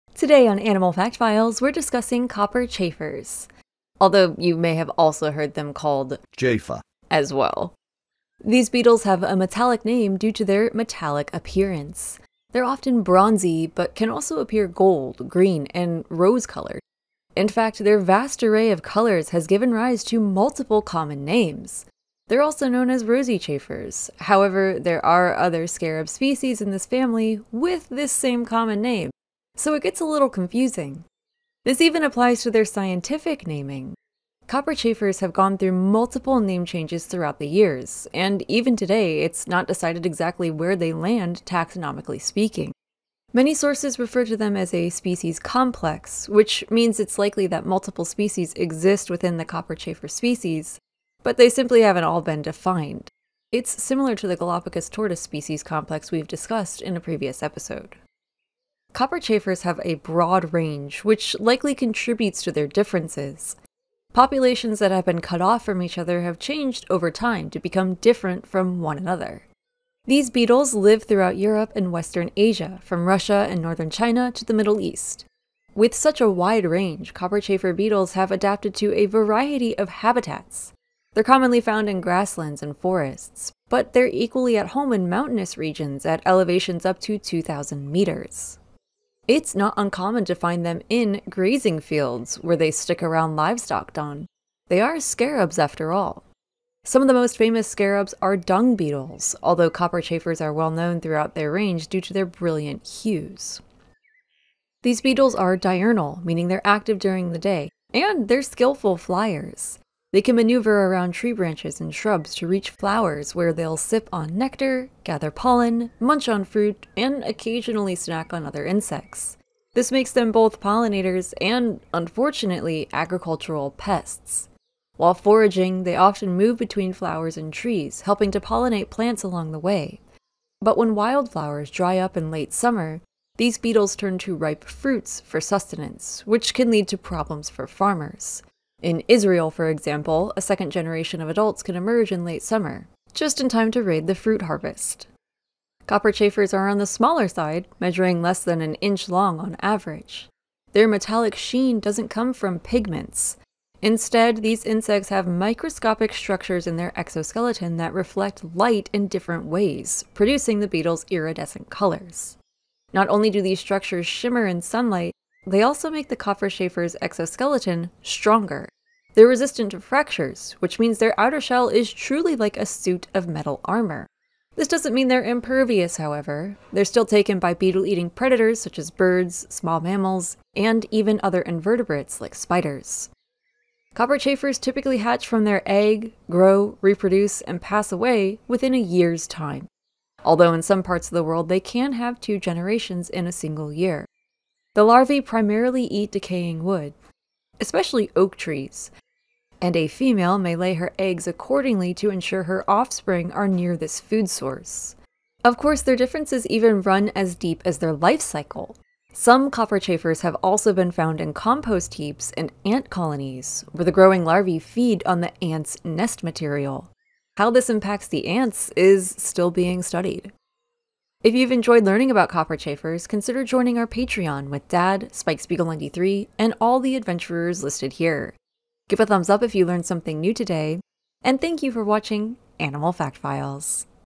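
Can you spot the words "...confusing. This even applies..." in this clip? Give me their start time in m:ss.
0:30.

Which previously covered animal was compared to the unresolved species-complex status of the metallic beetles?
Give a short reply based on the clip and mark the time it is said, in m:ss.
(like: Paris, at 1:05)
Galapagos tortoise, at 0:54.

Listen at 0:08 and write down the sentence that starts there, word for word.
These beetles have a metallic name due to their metallic appearance.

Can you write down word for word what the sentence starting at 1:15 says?
With such a wide range, copperchafer beetles have adapted to a variety of habitats.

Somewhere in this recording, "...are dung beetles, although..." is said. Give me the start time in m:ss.
1:38.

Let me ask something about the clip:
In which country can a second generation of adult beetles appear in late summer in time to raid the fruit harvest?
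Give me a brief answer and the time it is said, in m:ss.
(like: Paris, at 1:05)
Israel, at 2:19.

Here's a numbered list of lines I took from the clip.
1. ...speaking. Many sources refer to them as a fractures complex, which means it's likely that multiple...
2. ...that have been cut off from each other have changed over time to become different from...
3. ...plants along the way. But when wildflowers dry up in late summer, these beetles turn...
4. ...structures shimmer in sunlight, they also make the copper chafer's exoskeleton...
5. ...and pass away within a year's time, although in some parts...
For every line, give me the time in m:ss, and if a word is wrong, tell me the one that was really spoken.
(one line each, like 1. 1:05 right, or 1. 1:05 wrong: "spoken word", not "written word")
1. 0:42 wrong: "species", not "fractures"
2. 1:04 right
3. 2:08 right
4. 2:43 right
5. 3:07 right.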